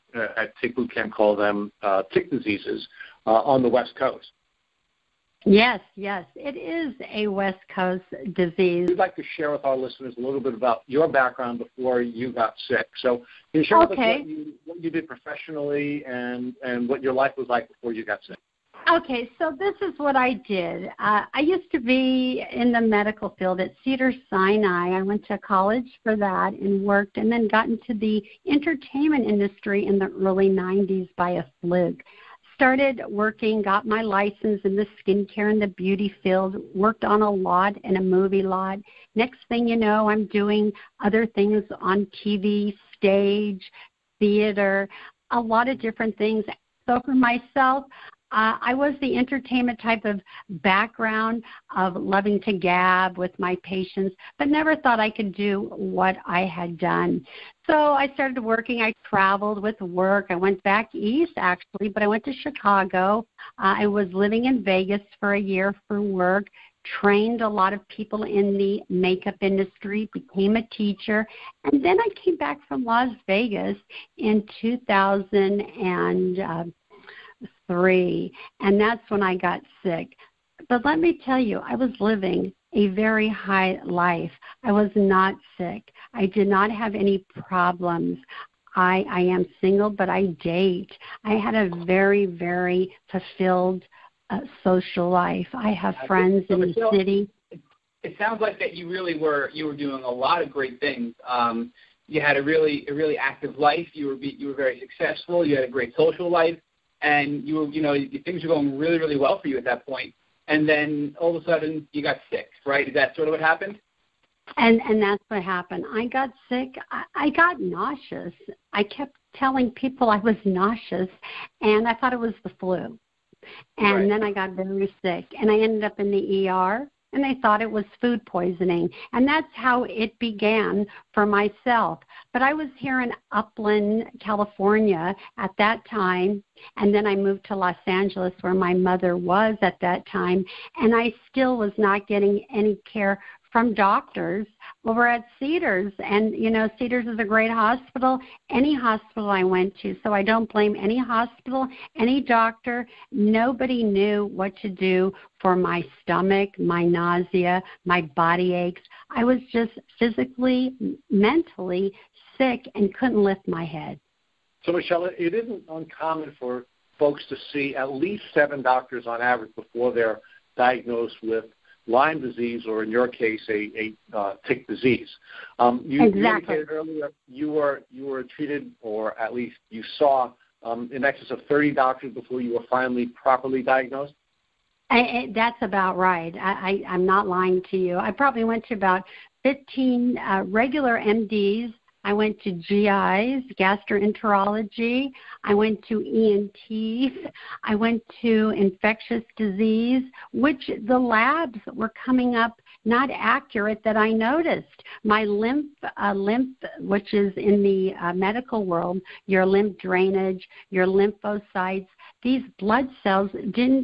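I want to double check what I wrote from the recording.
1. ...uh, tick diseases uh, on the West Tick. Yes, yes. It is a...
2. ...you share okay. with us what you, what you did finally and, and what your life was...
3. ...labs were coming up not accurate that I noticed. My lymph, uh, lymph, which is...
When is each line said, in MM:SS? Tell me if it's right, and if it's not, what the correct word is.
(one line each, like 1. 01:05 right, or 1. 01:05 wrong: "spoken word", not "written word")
1. 00:01 wrong: "Coast", not "Tick"
2. 00:13 wrong: "professionally", not "finally"
3. 03:20 right.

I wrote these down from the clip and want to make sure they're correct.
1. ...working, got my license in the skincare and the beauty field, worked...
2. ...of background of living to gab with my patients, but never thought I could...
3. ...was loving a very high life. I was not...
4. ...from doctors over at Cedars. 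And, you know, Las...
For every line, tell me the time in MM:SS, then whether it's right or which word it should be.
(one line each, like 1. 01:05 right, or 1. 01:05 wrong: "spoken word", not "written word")
1. 00:33 right
2. 00:50 wrong: "loving", not "living"
3. 01:21 wrong: "living", not "loving"
4. 02:23 wrong: "Cedars", not "Las".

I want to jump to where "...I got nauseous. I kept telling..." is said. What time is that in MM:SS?
01:57.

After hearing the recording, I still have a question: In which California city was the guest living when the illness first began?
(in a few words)
Upland.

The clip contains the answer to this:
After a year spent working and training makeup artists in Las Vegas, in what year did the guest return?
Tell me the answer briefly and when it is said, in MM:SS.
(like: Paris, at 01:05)
2003, at 01:14.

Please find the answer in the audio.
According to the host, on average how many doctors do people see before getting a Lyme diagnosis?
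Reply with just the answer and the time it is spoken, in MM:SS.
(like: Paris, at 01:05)
7, at 02:48.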